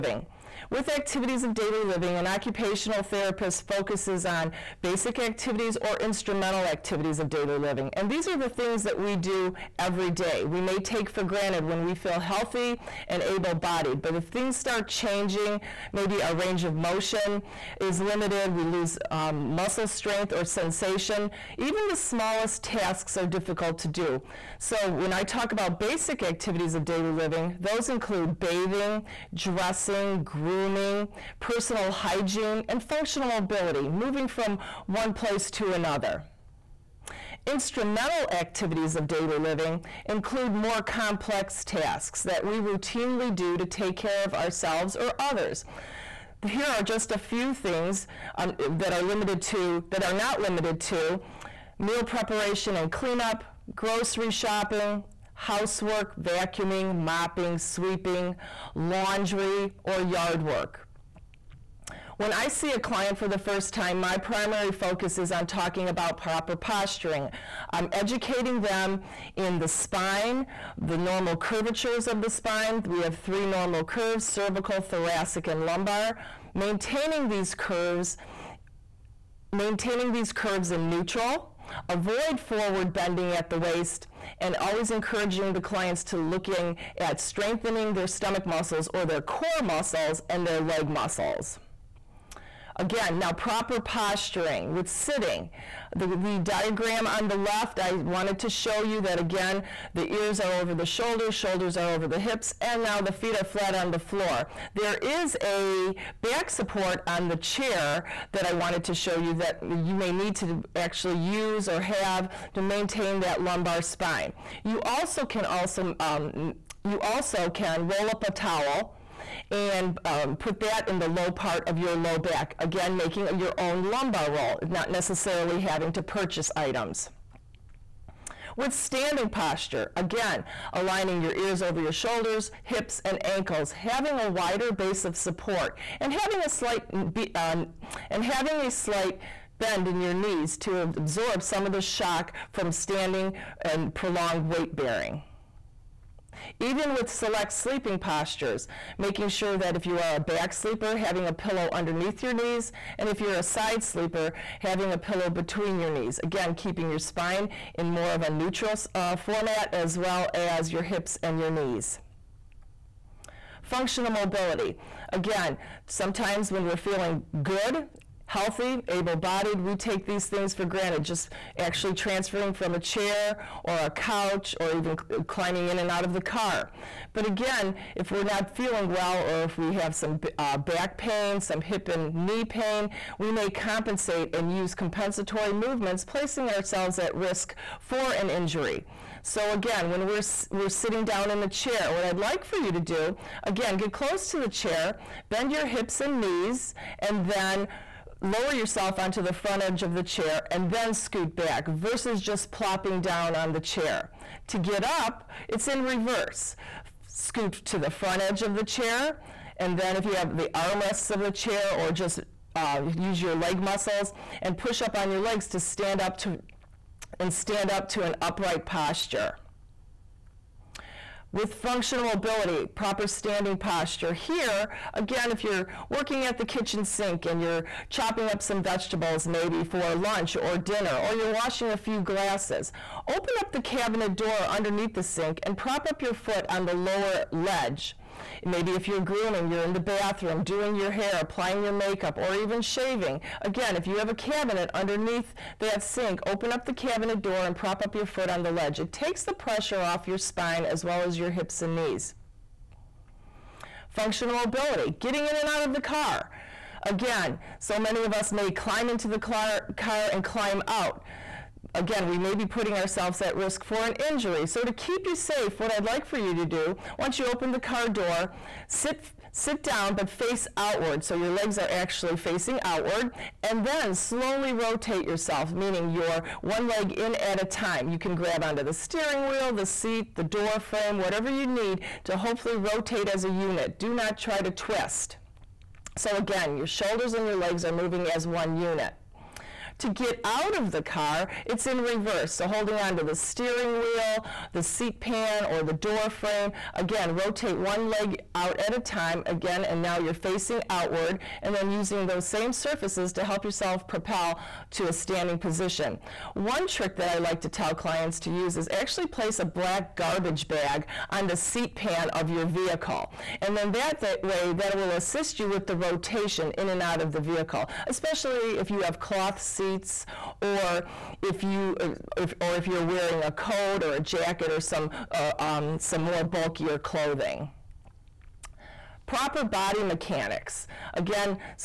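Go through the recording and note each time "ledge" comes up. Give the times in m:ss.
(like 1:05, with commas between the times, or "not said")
3:57, 4:08.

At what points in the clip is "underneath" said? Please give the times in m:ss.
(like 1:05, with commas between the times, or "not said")
2:31, 3:54, 4:04.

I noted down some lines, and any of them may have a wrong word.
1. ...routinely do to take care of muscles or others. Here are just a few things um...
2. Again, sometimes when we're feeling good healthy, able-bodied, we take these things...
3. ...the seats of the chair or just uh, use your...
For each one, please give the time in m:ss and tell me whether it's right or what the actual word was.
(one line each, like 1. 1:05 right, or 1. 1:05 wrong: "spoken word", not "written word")
1. 0:42 wrong: "ourselves", not "muscles"
2. 2:45 right
3. 3:30 wrong: "armrests", not "seats".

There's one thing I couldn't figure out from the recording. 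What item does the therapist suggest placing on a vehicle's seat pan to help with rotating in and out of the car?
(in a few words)
Black garbage bag.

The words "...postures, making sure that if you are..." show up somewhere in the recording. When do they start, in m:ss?
2:27.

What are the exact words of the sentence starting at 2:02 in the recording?
Again, making your own lumbar roll, not necessarily having to purchase items with standing posture.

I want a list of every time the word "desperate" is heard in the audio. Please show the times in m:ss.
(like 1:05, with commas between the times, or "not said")
not said.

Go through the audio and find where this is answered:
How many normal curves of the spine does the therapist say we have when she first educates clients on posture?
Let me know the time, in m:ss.
1:13.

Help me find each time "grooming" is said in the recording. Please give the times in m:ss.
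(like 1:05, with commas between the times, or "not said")
0:30, 3:58.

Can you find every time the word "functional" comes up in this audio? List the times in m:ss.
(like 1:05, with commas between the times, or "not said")
0:32, 2:43, 3:41, 4:13.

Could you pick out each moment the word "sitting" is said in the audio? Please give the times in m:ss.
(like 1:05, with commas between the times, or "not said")
1:34, 3:10.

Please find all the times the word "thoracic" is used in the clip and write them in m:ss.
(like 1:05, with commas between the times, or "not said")
1:14.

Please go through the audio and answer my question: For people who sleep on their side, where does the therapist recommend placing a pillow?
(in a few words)
Between your knees.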